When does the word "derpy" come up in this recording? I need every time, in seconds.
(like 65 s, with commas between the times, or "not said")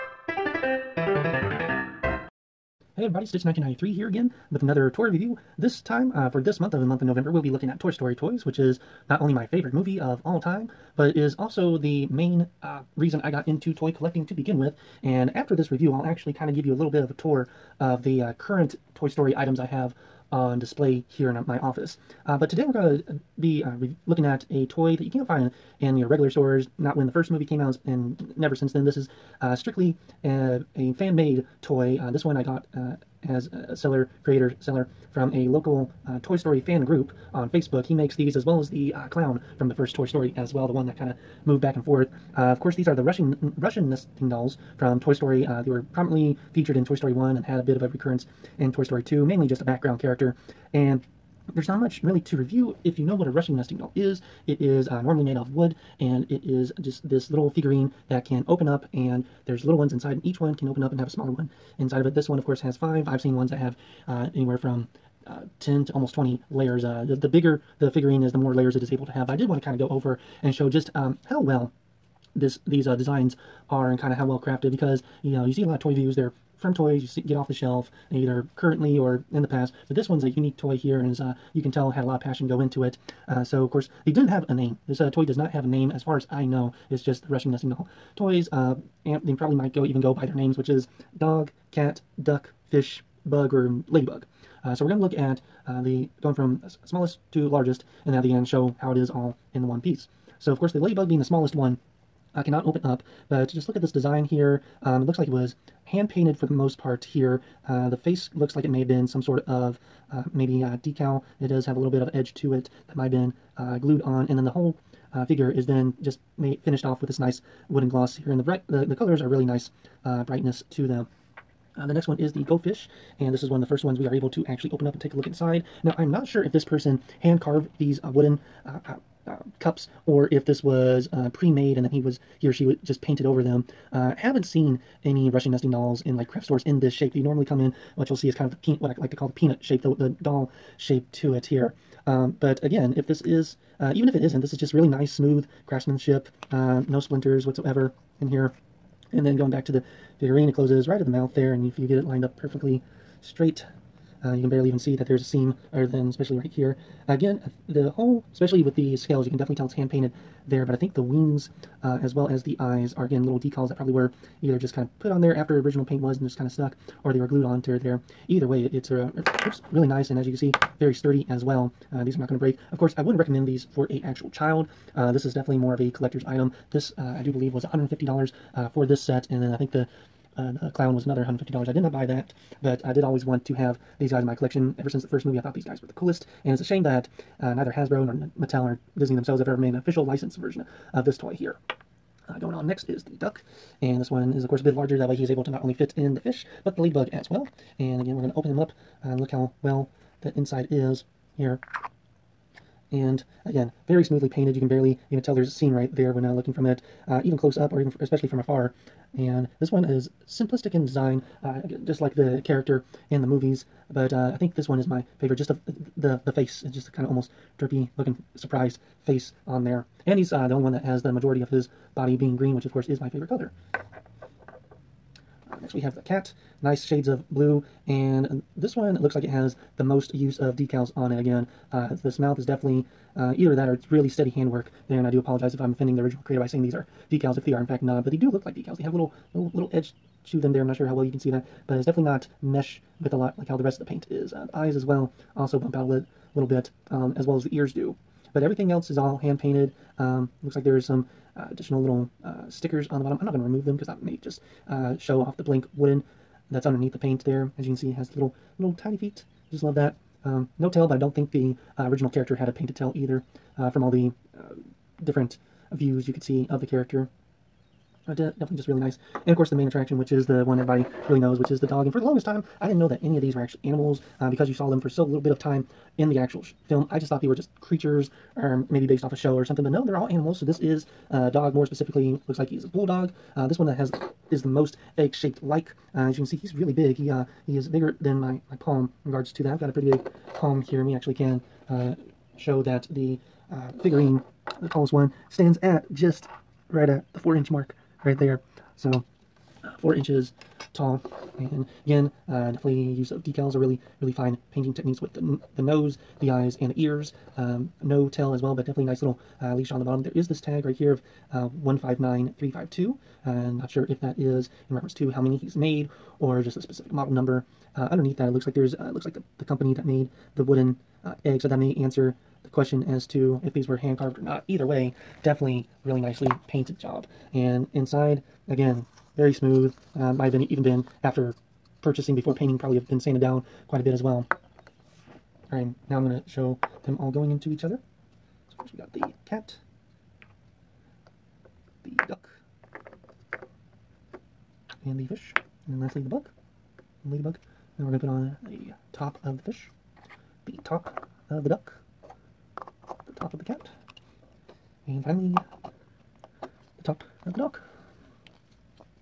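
217 s.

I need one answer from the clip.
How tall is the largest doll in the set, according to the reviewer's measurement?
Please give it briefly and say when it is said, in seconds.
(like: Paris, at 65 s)
4 inches, at 299 s.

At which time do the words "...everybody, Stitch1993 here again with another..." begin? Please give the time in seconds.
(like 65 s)
3 s.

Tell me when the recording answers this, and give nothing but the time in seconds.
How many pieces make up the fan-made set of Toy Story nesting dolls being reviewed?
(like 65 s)
62 s.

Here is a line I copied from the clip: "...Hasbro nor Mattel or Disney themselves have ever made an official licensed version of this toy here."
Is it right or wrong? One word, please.
right.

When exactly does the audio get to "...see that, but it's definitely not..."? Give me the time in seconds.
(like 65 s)
241 s.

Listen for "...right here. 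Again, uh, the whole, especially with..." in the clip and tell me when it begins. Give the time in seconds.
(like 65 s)
156 s.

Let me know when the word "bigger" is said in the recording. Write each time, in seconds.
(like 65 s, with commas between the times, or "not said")
67 s, 287 s.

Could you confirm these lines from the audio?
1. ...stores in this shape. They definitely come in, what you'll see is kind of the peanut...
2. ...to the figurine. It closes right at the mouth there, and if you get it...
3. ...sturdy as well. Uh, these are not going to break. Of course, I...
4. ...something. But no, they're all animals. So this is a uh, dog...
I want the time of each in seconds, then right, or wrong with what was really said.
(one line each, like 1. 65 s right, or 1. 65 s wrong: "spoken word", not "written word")
1. 136 s wrong: "normally", not "definitely"
2. 149 s right
3. 170 s right
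4. 279 s right.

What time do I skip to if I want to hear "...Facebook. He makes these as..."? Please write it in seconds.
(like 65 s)
37 s.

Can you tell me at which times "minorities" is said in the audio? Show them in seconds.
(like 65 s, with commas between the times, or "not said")
not said.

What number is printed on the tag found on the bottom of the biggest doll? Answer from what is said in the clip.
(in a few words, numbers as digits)
159352.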